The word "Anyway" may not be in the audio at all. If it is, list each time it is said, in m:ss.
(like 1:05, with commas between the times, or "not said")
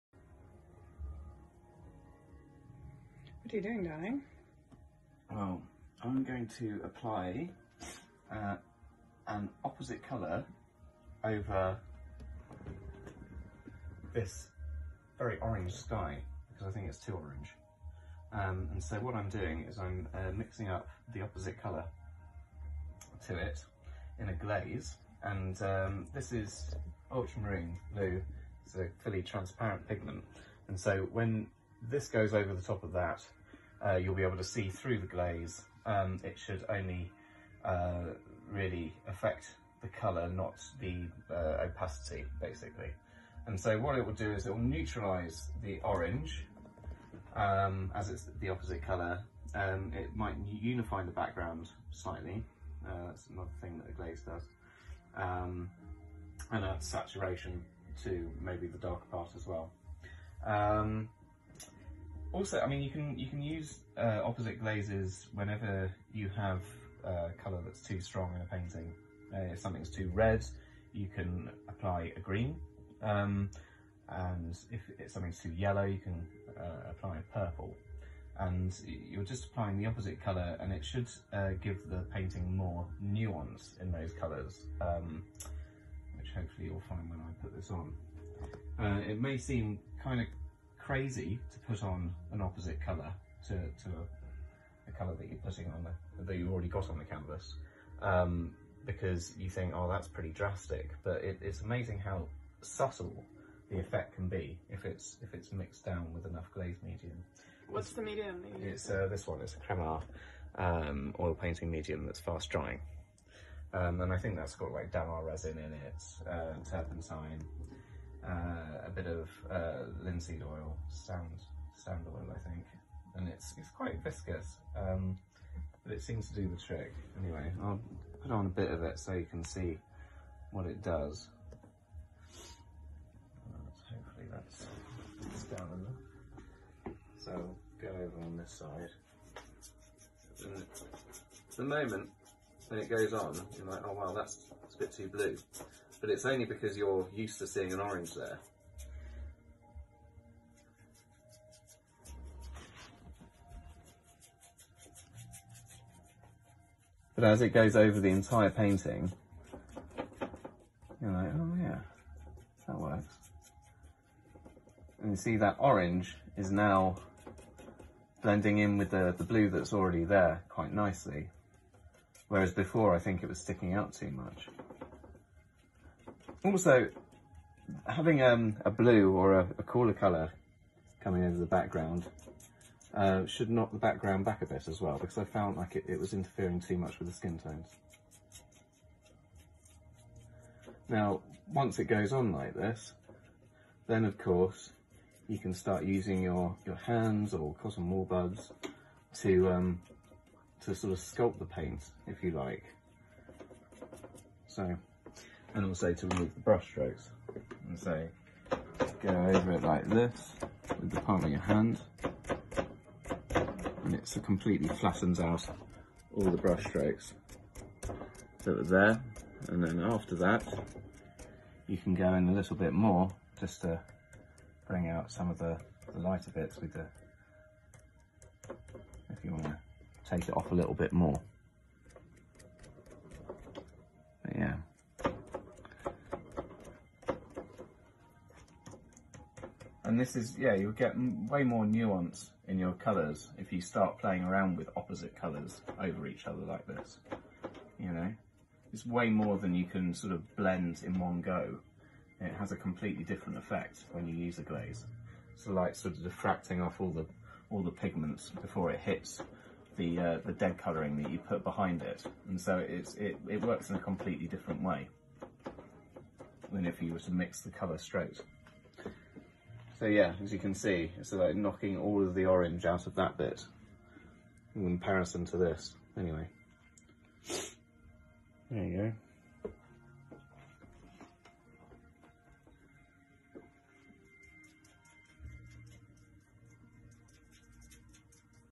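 2:07, 4:35.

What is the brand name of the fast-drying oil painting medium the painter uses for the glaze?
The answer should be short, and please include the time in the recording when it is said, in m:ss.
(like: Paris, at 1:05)
Cremar, at 1:49.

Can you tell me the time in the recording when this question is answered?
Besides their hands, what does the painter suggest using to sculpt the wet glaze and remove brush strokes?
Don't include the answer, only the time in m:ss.
3:17.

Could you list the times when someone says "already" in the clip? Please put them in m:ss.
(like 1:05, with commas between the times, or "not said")
1:36, 2:49.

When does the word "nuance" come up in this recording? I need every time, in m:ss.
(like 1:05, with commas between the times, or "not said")
1:23, 4:01.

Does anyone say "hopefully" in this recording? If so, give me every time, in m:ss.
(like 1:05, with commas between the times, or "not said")
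1:26, 2:13.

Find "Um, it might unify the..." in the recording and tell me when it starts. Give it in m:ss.
0:49.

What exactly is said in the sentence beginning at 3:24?
So and also to remove the brush strokes.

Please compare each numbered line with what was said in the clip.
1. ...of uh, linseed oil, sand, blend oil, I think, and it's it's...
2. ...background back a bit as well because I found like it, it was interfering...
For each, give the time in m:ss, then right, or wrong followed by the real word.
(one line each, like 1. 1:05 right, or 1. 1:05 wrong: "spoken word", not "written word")
1. 1:59 wrong: "stand", not "blend"
2. 3:03 right.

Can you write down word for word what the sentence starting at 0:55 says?
Um, and add saturation to maybe the darker part as well.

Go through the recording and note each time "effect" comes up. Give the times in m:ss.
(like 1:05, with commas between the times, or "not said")
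1:43, 4:13.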